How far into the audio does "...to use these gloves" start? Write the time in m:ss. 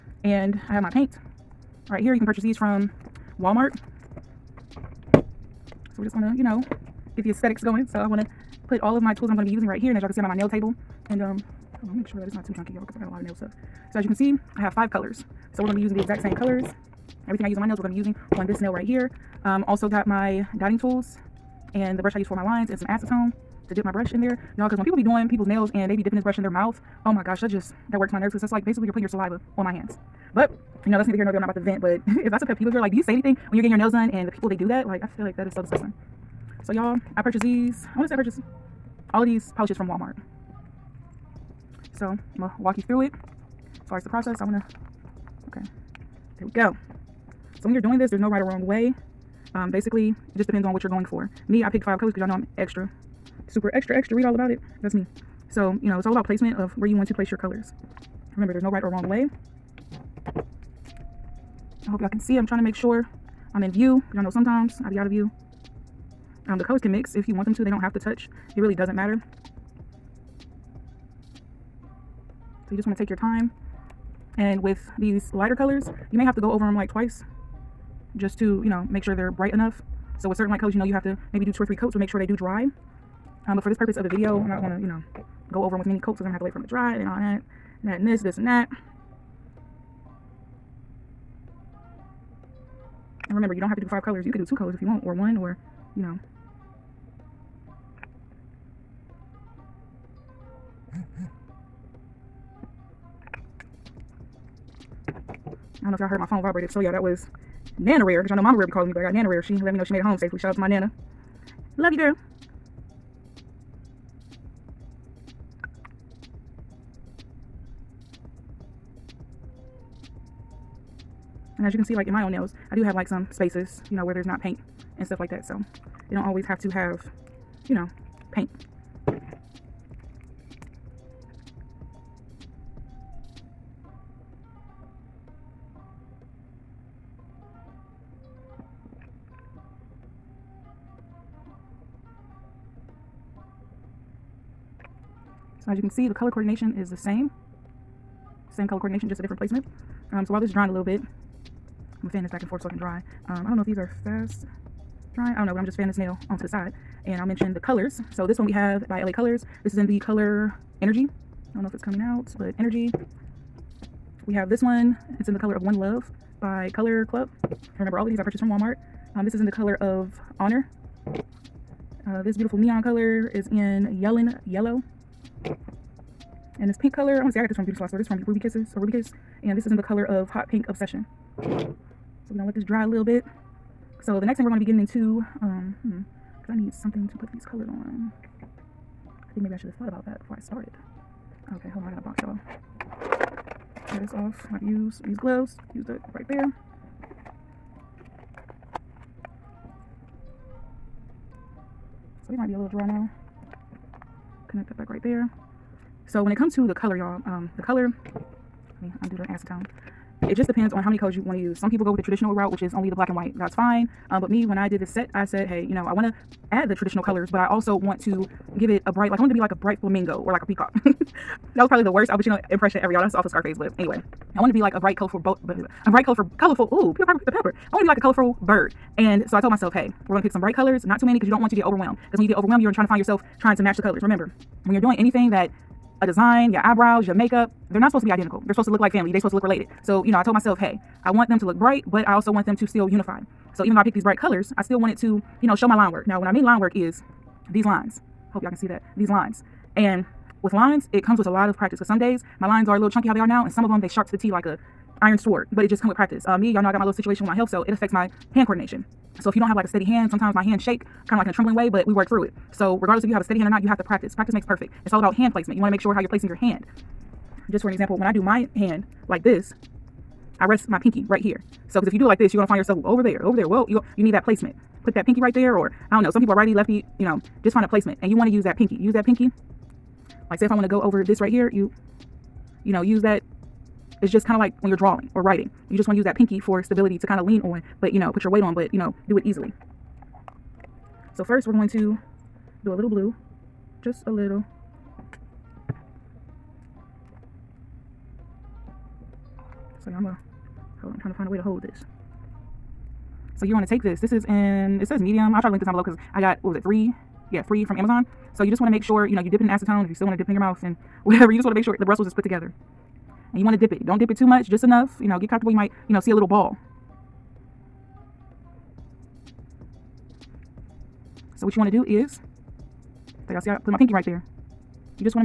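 3:14.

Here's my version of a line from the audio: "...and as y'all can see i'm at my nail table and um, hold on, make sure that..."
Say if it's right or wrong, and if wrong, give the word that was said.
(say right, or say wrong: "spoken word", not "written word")
right.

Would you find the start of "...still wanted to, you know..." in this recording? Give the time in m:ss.
4:04.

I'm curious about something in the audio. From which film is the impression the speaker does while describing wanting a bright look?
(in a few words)
Scarface.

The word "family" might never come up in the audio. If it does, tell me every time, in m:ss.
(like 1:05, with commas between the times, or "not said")
3:58.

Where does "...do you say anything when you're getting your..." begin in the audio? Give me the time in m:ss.
0:32.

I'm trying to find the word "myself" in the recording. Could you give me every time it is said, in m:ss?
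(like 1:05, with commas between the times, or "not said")
3:49, 4:00.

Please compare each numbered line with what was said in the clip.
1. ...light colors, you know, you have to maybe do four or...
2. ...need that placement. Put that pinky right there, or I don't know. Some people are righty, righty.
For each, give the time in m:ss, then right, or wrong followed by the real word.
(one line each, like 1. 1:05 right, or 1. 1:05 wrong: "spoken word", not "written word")
1. 1:20 wrong: "two", not "four"
2. 4:34 wrong: "lefty", not "righty".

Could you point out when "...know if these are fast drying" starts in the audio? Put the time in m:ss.
2:33.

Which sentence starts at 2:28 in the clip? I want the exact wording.
Same color coordination, just a different placement.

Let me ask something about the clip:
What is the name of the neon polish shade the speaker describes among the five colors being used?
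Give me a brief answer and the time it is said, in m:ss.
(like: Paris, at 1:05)
Yellen Yellow, at 2:54.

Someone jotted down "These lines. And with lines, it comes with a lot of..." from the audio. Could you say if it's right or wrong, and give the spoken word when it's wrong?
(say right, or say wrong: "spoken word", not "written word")
right.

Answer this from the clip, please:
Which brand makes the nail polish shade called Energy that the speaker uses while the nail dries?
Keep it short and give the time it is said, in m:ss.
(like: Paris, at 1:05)
LA Colors, at 2:39.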